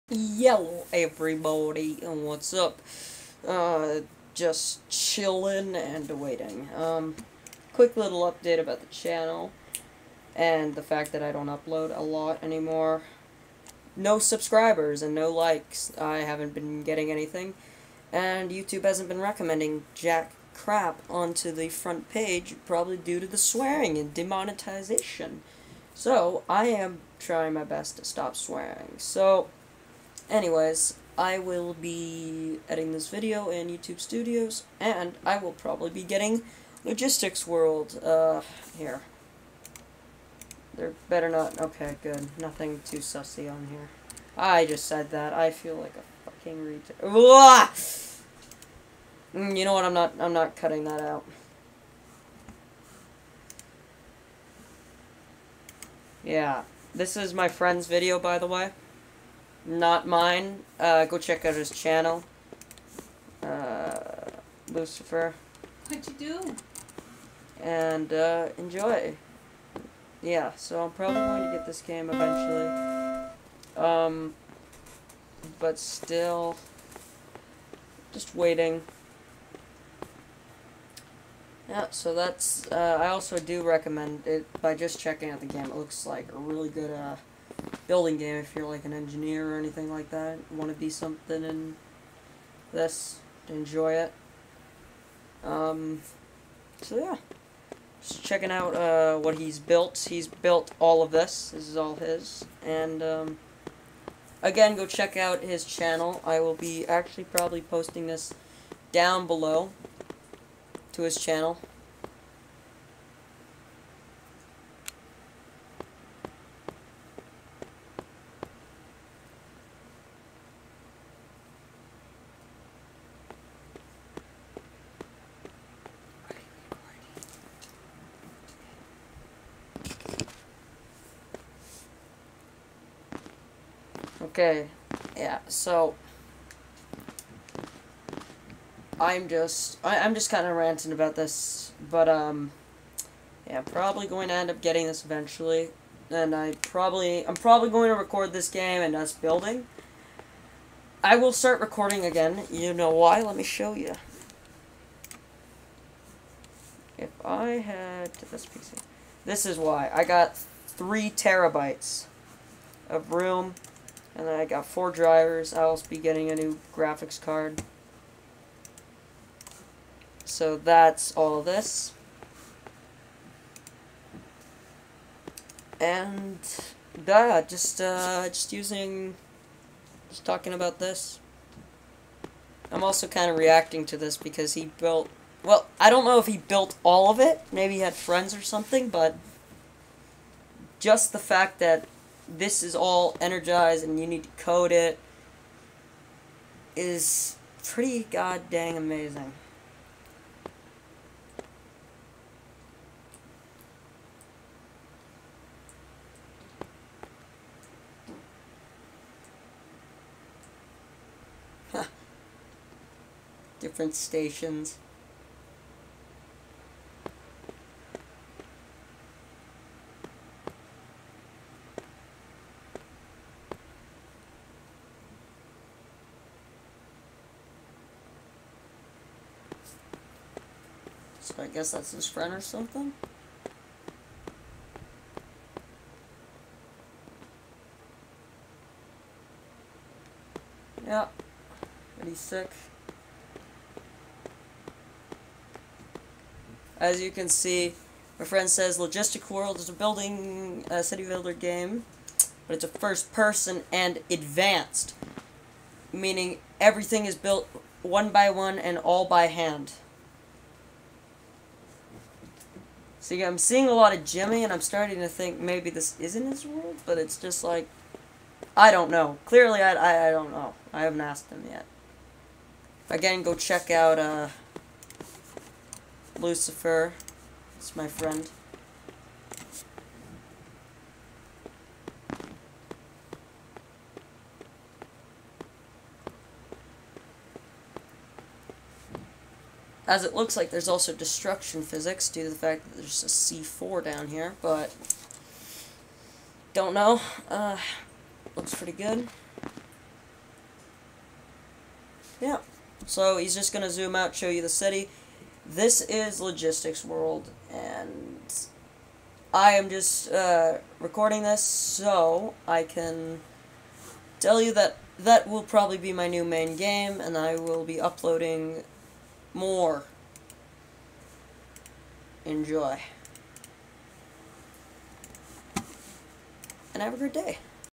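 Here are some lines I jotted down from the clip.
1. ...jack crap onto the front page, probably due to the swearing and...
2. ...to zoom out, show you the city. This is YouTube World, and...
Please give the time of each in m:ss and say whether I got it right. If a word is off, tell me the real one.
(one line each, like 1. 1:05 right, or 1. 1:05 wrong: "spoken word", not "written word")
1. 0:19 right
2. 5:03 wrong: "Logistics", not "YouTube".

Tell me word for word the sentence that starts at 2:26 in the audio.
And I probably I'm probably going to record this game and us building.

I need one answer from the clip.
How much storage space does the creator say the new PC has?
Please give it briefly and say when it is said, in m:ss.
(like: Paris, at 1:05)
3 terabytes, at 2:40.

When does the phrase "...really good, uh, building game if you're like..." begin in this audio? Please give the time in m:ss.
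1:26.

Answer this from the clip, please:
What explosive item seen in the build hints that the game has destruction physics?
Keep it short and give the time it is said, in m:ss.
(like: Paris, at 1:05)
C4, at 4:53.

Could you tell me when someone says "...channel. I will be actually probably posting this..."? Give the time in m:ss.
1:45.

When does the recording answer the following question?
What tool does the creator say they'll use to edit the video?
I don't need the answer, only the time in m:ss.
0:33.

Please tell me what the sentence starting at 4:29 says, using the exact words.
Clearly, I, I, I don't know.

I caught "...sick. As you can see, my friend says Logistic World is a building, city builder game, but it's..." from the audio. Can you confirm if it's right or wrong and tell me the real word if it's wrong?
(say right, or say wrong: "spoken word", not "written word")
right.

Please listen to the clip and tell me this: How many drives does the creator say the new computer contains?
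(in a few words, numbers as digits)
4.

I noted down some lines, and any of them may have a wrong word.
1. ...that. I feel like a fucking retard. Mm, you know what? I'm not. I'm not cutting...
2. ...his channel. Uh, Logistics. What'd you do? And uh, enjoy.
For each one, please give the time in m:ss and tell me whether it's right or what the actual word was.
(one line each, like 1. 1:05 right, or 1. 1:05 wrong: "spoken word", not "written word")
1. 0:45 right
2. 1:01 wrong: "Lucifer", not "Logistics".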